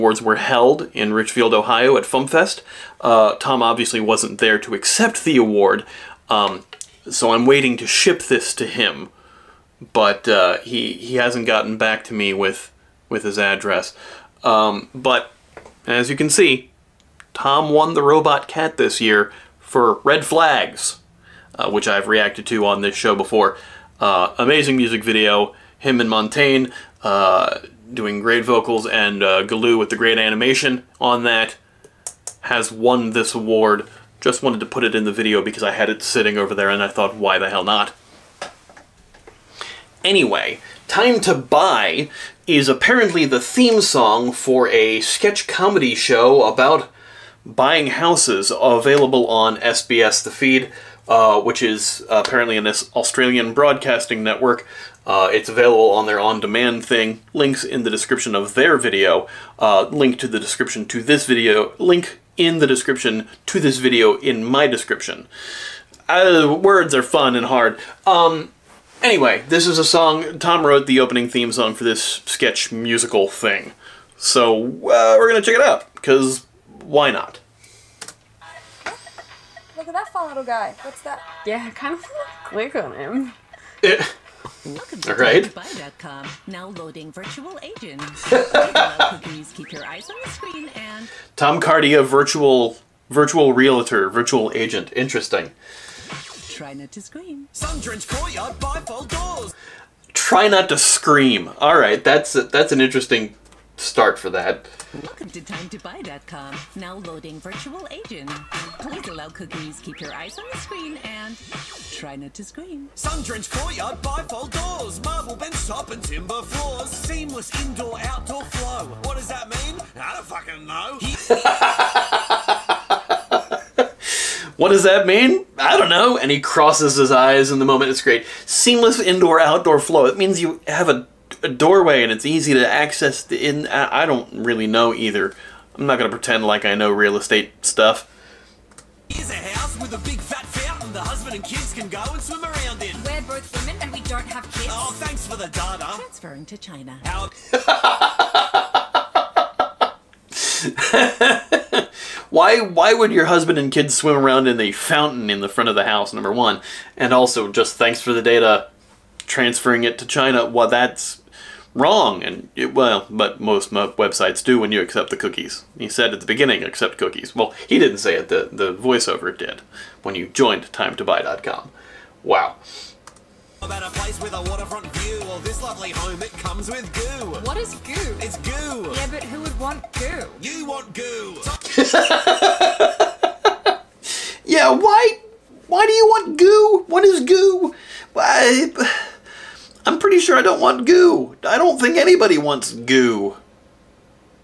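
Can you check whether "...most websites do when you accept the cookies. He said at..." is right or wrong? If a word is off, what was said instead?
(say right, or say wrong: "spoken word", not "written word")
right.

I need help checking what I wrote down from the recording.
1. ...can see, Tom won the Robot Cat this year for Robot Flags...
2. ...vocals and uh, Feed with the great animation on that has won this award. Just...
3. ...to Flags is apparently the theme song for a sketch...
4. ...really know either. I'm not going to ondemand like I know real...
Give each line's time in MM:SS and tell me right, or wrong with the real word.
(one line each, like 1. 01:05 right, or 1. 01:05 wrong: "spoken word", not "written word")
1. 00:16 wrong: "Red", not "Robot"
2. 00:28 wrong: "Galoo", not "Feed"
3. 00:41 wrong: "Buy", not "Flags"
4. 02:14 wrong: "pretend", not "ondemand".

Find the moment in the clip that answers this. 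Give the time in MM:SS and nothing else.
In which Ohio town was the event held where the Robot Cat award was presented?
00:01.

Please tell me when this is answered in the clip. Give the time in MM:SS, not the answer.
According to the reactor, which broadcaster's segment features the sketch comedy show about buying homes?
00:49.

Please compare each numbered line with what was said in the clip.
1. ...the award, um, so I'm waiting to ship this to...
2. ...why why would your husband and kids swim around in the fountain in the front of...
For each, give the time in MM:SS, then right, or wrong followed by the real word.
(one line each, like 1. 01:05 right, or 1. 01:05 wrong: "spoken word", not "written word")
1. 00:05 right
2. 02:32 right.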